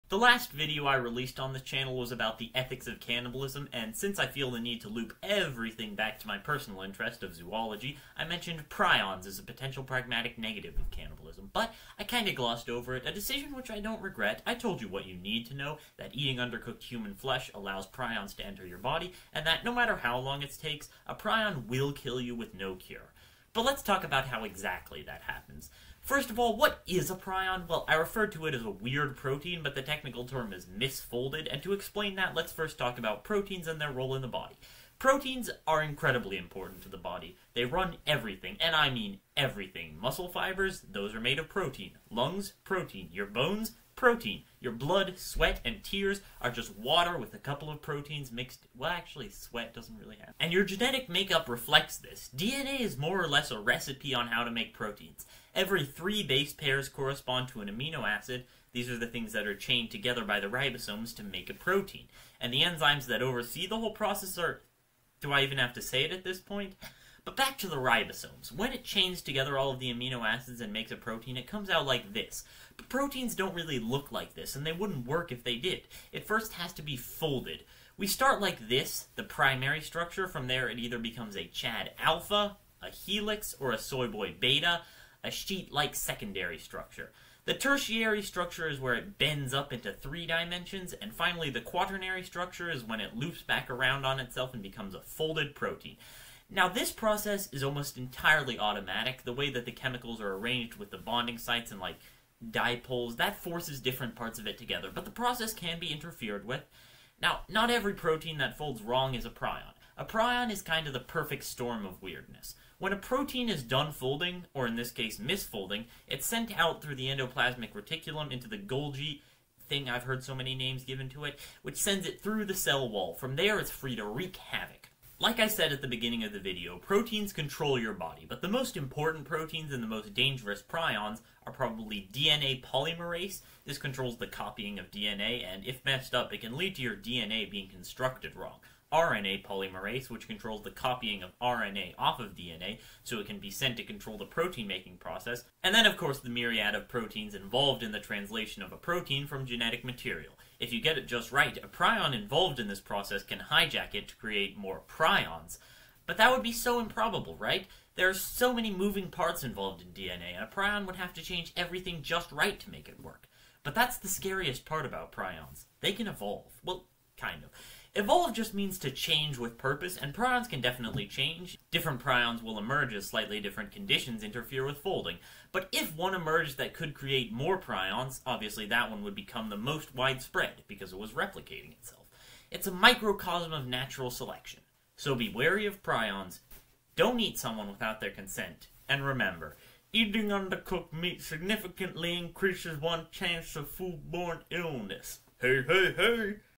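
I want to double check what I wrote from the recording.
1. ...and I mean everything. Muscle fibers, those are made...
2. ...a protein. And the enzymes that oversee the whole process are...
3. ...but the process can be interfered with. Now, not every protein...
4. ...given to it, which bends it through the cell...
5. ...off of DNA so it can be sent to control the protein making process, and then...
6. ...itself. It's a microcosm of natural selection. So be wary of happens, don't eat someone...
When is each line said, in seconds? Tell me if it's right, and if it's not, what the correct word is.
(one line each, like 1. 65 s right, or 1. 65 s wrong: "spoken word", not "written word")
1. 38 s right
2. 61 s right
3. 104 s right
4. 120 s wrong: "sends", not "bends"
5. 141 s right
6. 181 s wrong: "prions", not "happens".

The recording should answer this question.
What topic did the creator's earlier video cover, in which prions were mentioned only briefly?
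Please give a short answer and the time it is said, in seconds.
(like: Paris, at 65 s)
ethics of cannibalism, at 2 s.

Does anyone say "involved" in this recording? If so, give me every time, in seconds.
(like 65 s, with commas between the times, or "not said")
147 s, 152 s, 159 s.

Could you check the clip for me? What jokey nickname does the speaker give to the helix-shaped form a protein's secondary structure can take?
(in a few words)
Chad alpha.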